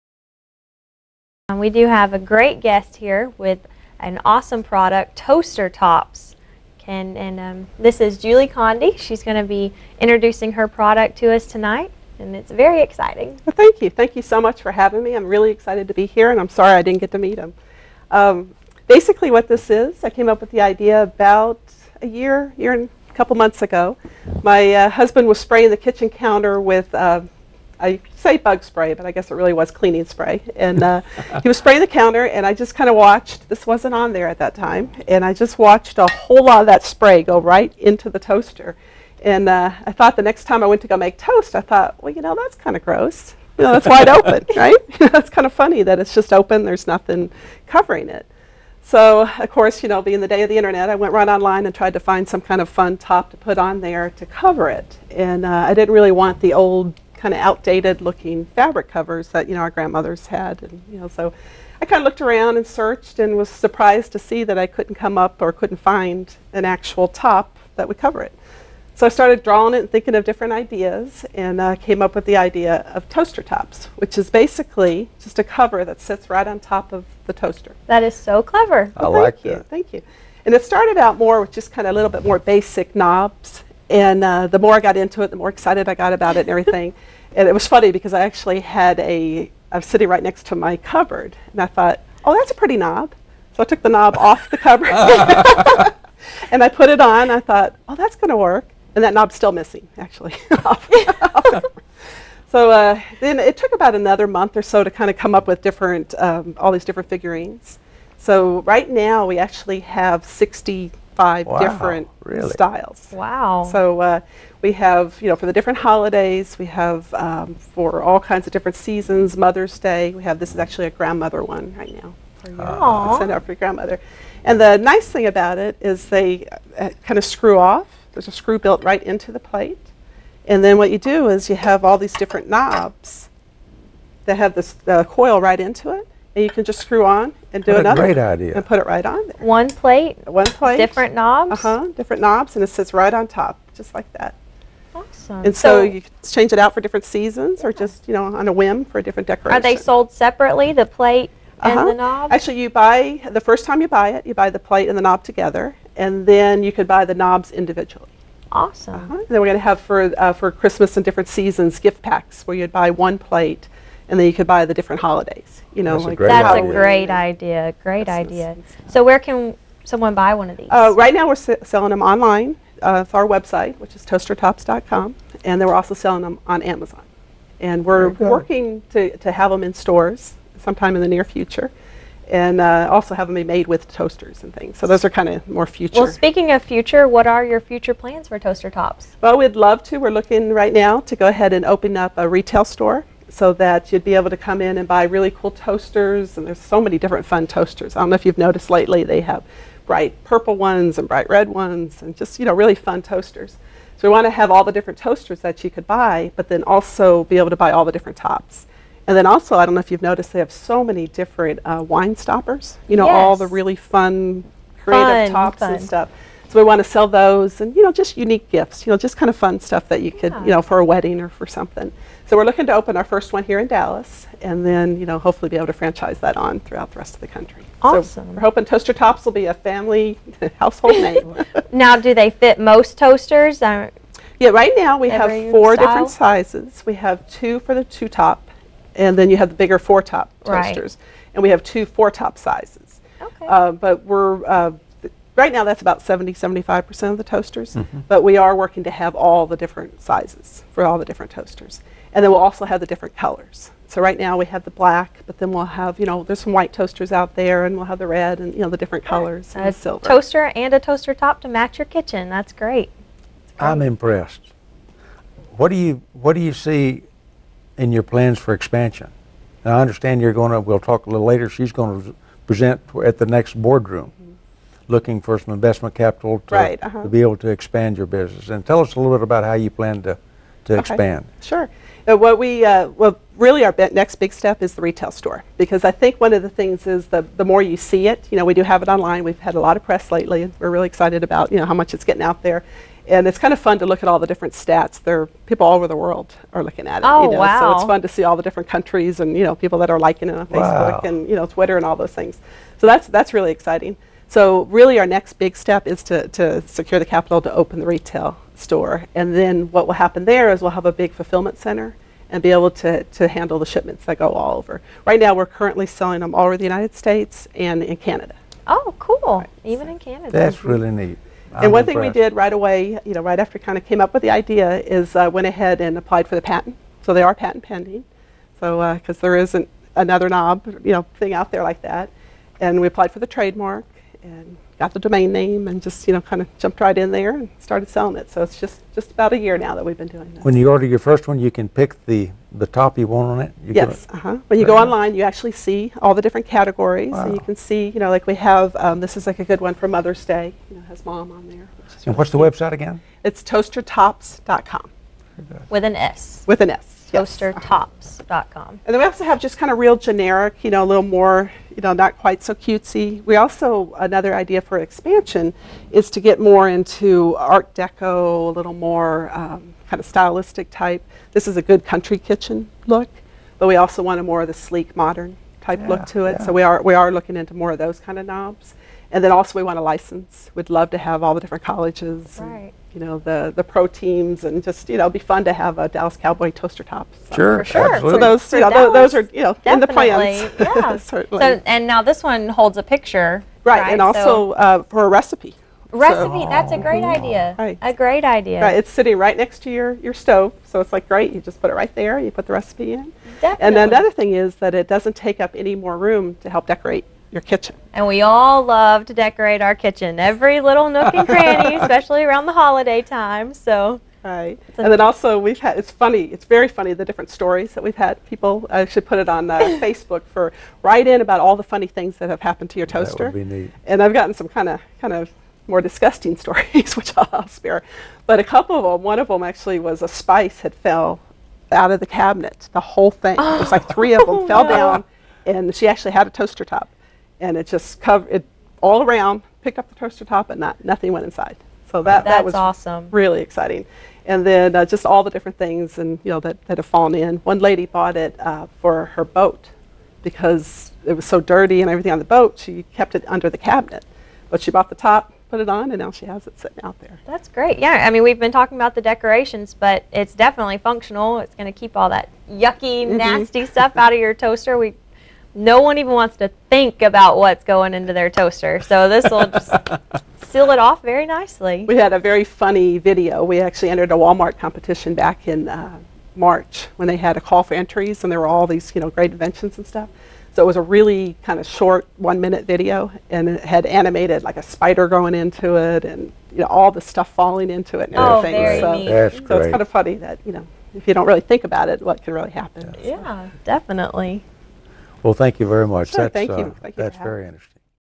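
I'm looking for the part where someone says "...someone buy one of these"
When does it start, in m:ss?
2:49.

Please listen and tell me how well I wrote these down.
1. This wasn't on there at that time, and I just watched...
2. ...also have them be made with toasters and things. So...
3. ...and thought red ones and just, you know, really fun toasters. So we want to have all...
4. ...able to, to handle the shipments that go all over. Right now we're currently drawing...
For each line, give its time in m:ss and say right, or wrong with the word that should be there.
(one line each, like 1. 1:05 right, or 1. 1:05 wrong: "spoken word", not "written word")
1. 0:33 right
2. 3:02 right
3. 3:20 wrong: "bright", not "thought"
4. 5:12 wrong: "selling", not "drawing".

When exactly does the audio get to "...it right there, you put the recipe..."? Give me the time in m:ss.
6:41.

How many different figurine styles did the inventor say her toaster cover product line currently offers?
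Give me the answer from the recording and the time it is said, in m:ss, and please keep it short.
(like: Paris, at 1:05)
65, at 1:50.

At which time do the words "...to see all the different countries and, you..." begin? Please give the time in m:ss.
4:58.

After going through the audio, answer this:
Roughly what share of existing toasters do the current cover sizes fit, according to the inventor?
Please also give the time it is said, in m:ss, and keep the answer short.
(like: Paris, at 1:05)
70-75%, at 4:06.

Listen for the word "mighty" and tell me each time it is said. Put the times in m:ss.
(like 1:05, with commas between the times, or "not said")
not said.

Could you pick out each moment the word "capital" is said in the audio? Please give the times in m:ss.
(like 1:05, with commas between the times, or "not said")
4:36, 5:07.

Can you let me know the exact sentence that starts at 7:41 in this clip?
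It's going to keep all that yucky, mm -hmm.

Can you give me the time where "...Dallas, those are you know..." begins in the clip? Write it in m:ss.
6:28.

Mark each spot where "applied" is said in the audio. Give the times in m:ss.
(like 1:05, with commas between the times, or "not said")
5:25, 5:32.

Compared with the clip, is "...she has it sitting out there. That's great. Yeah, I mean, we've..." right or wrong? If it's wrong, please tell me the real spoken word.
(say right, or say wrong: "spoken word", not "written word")
right.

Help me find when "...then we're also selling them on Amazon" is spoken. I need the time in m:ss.
2:55.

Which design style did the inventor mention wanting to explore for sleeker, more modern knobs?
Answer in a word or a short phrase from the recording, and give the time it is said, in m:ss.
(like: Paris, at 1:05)
Art Deco, at 6:07.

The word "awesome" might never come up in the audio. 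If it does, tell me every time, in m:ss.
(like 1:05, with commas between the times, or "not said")
0:04, 2:24, 2:38, 3:47, 7:22.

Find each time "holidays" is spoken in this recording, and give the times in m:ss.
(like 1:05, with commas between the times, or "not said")
1:55, 2:45, 6:52.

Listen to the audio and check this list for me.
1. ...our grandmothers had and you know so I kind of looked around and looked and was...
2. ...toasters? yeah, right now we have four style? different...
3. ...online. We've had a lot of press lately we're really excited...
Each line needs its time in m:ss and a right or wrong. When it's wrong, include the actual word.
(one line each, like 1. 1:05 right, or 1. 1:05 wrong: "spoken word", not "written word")
1. 0:59 wrong: "searched", not "looked"
2. 3:52 right
3. 4:48 right.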